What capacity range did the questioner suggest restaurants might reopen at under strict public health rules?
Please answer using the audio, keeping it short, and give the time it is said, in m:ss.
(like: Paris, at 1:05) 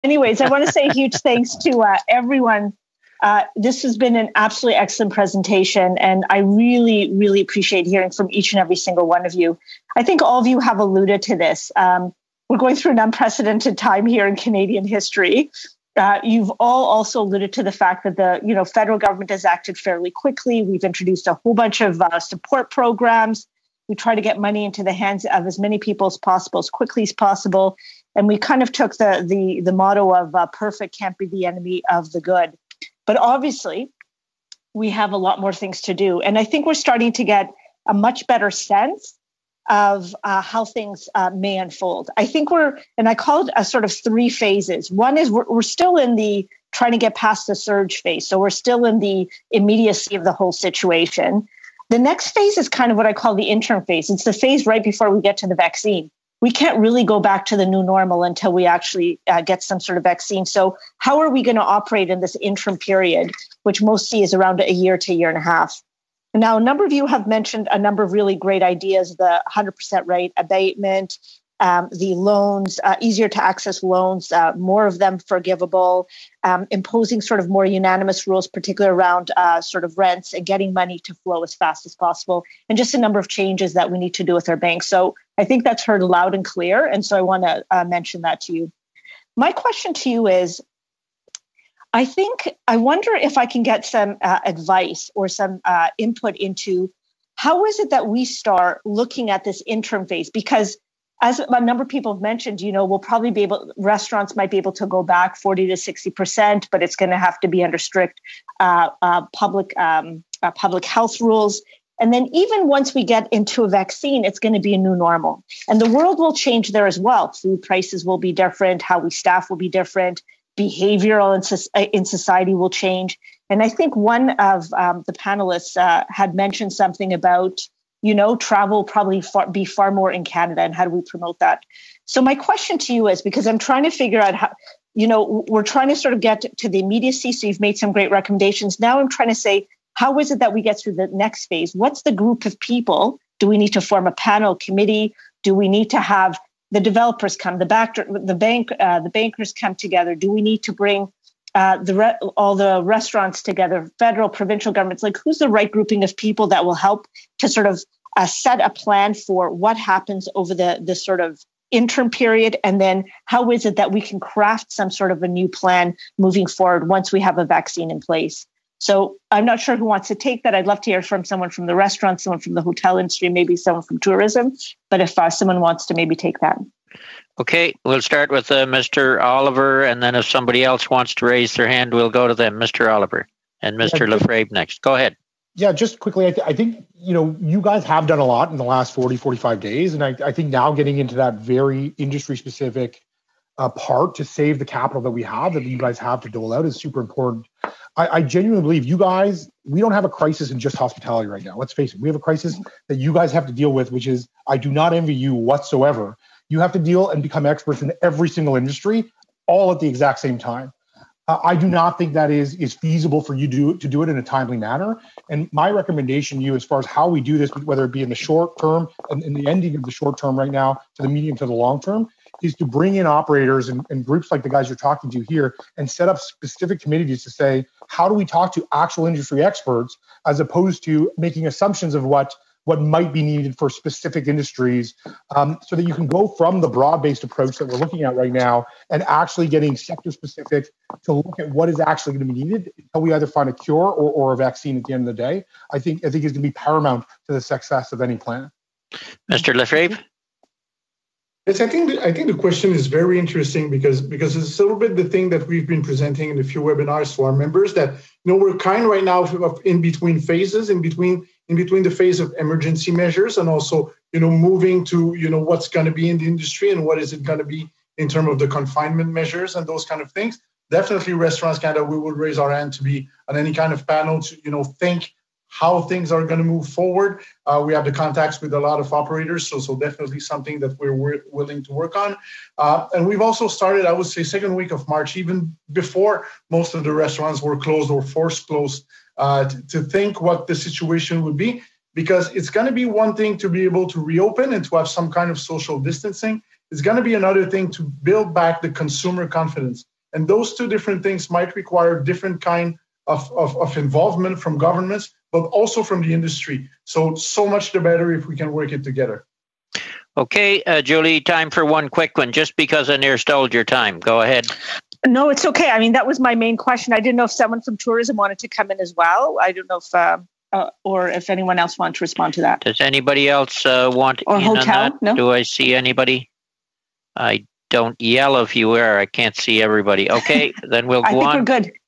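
40 to 60%, at 1:45.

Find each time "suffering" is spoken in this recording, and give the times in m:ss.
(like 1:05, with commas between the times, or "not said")
not said.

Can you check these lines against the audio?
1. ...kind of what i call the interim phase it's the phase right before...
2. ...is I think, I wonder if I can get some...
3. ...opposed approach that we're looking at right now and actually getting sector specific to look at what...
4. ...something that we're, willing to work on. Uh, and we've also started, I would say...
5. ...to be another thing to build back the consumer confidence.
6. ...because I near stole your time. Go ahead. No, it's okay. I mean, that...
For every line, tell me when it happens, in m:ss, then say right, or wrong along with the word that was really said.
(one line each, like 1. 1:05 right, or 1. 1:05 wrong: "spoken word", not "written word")
1. 0:52 right
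2. 1:30 right
3. 3:57 wrong: "based", not "opposed"
4. 4:40 right
5. 4:56 right
6. 5:12 right.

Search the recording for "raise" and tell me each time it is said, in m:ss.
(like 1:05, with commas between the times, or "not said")
3:01, 4:32.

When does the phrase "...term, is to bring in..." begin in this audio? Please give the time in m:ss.
3:41.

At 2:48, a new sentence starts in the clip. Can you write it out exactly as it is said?
So I'm not sure who wants to take that.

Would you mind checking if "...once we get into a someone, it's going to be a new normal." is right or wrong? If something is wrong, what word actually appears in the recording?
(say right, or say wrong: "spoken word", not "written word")
wrong: "vaccine", not "someone".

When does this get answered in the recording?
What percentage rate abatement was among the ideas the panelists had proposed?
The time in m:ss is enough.
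1:09.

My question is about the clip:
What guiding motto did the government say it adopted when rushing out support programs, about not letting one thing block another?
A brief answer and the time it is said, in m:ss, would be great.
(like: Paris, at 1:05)
Perfect can't be the enemy of the good, at 0:30.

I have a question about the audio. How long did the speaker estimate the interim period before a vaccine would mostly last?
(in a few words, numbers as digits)
A year to a year and a half.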